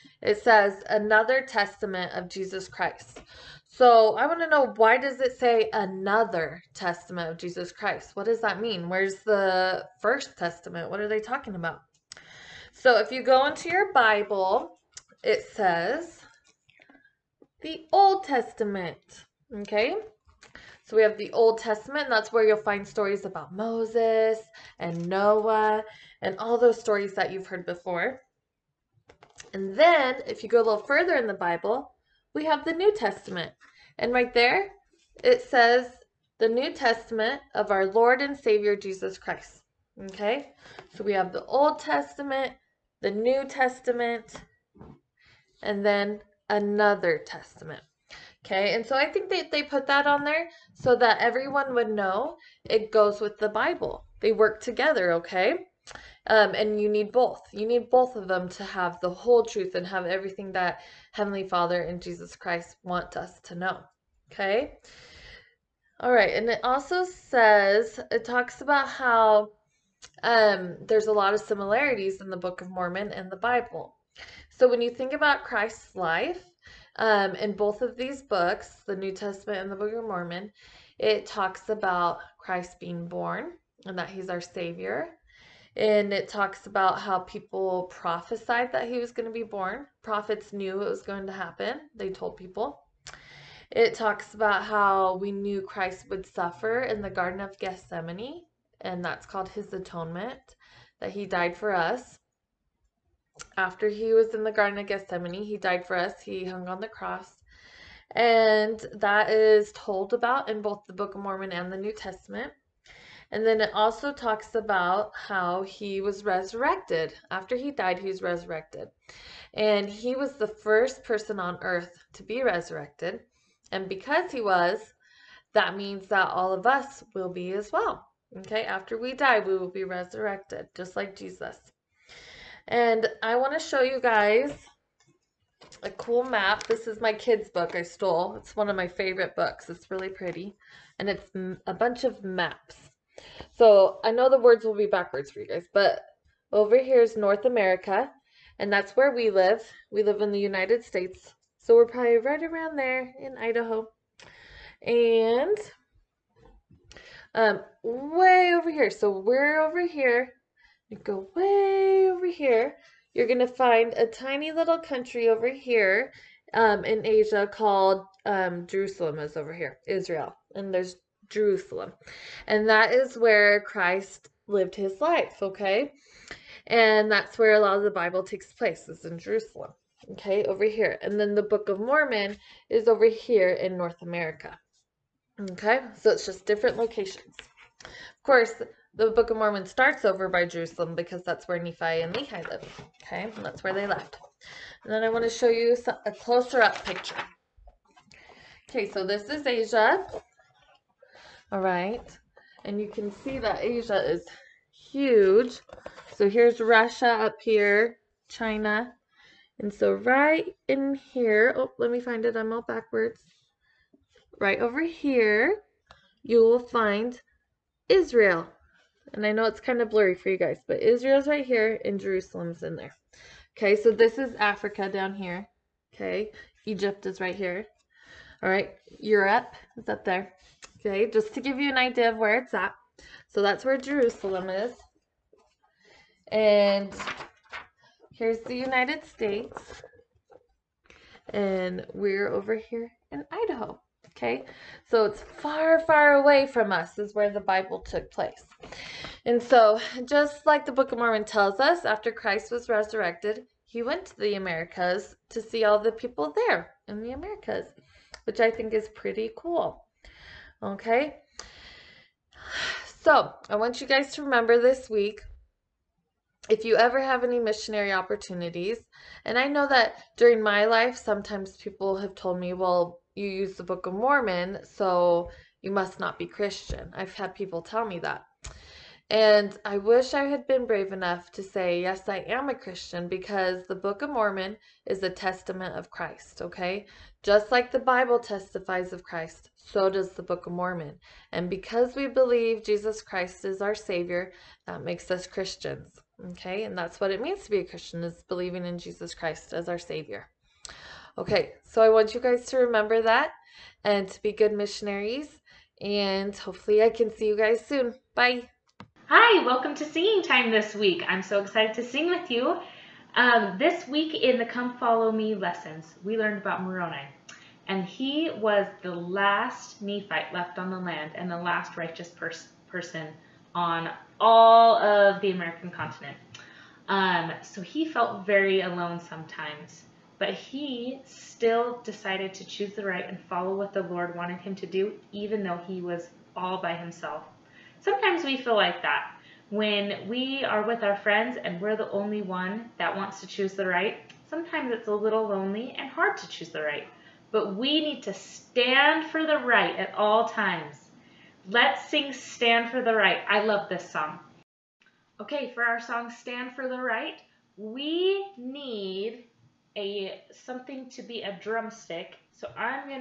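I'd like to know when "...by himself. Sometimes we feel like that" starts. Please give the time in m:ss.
5:36.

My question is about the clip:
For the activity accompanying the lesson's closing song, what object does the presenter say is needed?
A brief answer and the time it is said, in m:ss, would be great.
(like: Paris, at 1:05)
a drumstick, at 6:01.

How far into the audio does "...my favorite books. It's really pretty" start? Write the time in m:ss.
2:18.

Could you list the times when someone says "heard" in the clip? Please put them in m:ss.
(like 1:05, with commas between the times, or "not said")
0:27.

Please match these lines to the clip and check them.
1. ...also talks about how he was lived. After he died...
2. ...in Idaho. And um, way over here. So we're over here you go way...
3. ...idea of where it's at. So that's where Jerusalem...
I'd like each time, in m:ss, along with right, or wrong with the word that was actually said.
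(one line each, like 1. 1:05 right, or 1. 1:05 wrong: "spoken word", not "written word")
1. 1:53 wrong: "resurrected", not "lived"
2. 2:33 right
3. 3:51 right.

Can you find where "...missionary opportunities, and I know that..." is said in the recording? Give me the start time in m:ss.
4:27.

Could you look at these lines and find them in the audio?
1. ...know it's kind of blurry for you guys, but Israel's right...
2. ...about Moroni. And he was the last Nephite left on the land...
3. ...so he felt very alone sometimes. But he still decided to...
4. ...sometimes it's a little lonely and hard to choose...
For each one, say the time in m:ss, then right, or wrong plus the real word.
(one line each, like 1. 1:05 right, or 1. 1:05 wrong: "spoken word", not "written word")
1. 3:39 right
2. 5:16 right
3. 5:27 right
4. 5:44 right.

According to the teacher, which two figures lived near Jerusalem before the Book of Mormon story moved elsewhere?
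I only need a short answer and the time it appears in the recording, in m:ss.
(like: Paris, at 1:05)
Nephi and Lehi, at 3:11.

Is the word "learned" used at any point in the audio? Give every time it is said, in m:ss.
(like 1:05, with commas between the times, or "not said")
5:16.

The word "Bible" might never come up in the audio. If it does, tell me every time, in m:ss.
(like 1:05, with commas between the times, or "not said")
0:13, 0:31, 0:53, 1:13, 2:57, 4:07, 4:47.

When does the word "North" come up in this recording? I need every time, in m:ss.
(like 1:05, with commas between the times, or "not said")
2:27, 3:03.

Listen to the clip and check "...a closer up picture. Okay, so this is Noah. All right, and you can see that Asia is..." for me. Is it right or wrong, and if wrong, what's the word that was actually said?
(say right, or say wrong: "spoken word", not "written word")
wrong: "Asia", not "Noah".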